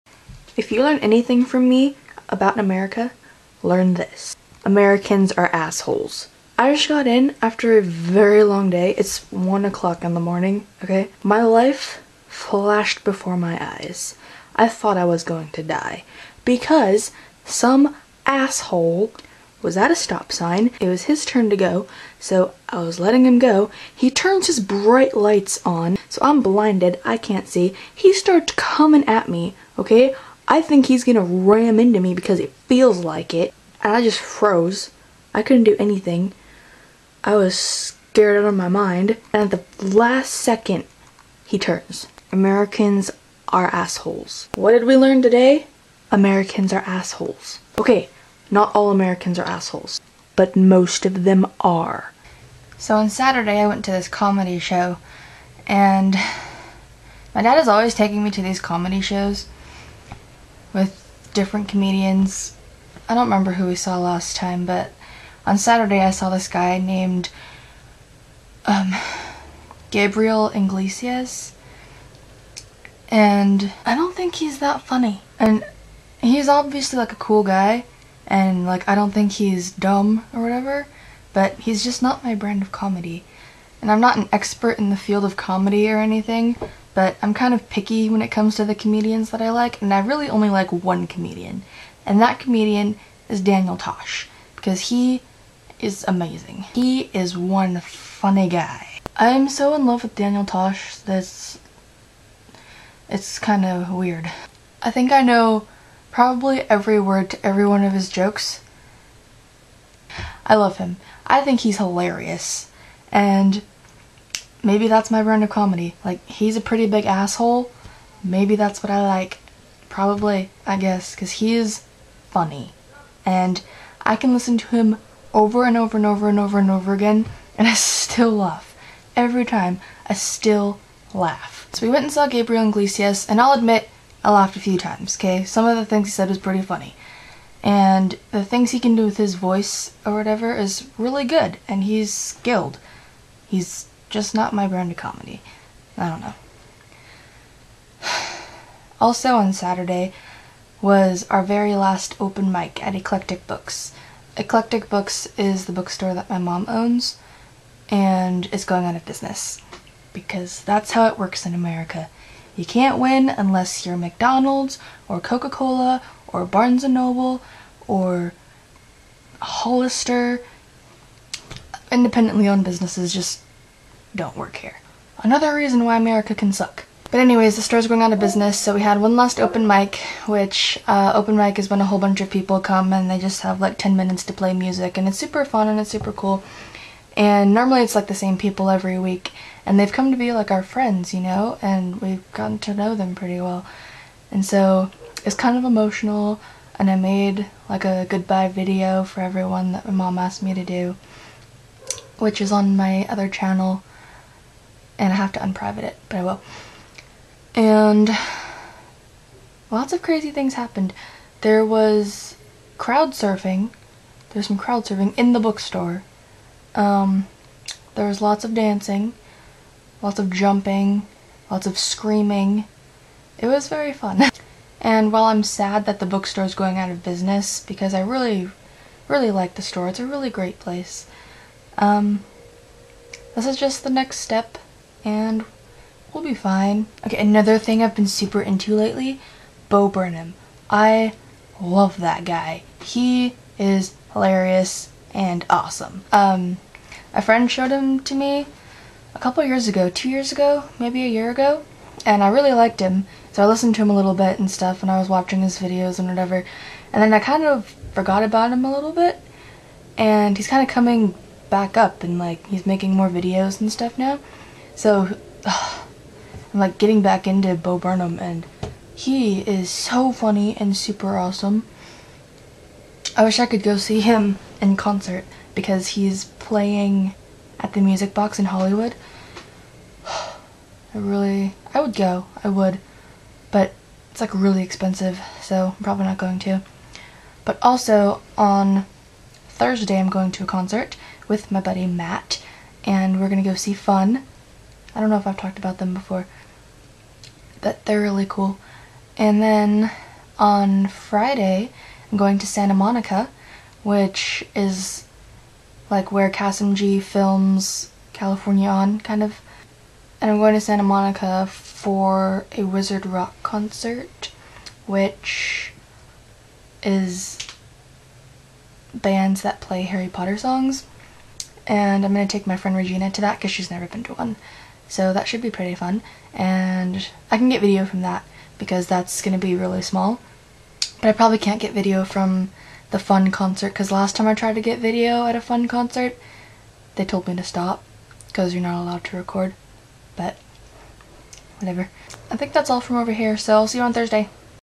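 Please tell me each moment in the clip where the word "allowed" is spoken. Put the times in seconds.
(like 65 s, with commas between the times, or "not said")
338 s.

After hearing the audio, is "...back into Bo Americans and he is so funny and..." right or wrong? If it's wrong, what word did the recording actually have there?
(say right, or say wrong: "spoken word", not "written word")
wrong: "Burnham", not "Americans".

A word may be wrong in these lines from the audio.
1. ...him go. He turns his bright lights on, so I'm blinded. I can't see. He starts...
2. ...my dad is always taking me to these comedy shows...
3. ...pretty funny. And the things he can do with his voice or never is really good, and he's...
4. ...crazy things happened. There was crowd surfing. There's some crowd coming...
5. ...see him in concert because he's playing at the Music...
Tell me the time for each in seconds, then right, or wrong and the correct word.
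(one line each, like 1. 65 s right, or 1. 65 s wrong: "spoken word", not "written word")
1. 23 s right
2. 57 s right
3. 136 s wrong: "whatever", not "never"
4. 210 s wrong: "surfing", not "coming"
5. 273 s right.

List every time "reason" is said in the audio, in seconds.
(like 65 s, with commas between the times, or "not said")
175 s.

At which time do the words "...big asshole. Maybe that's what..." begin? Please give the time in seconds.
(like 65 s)
116 s.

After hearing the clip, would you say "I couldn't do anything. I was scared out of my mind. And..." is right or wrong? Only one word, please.
right.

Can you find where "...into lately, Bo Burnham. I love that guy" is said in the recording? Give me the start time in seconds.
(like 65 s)
238 s.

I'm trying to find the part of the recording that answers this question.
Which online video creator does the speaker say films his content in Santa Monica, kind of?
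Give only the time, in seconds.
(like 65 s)
306 s.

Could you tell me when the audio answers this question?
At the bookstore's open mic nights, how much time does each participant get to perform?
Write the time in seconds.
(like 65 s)
183 s.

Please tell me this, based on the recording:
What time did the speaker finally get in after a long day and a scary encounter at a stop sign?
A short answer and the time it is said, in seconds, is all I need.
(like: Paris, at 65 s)
1 o'clock in the morning, at 9 s.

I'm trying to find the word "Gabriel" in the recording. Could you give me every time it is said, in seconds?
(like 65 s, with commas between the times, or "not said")
69 s, 132 s.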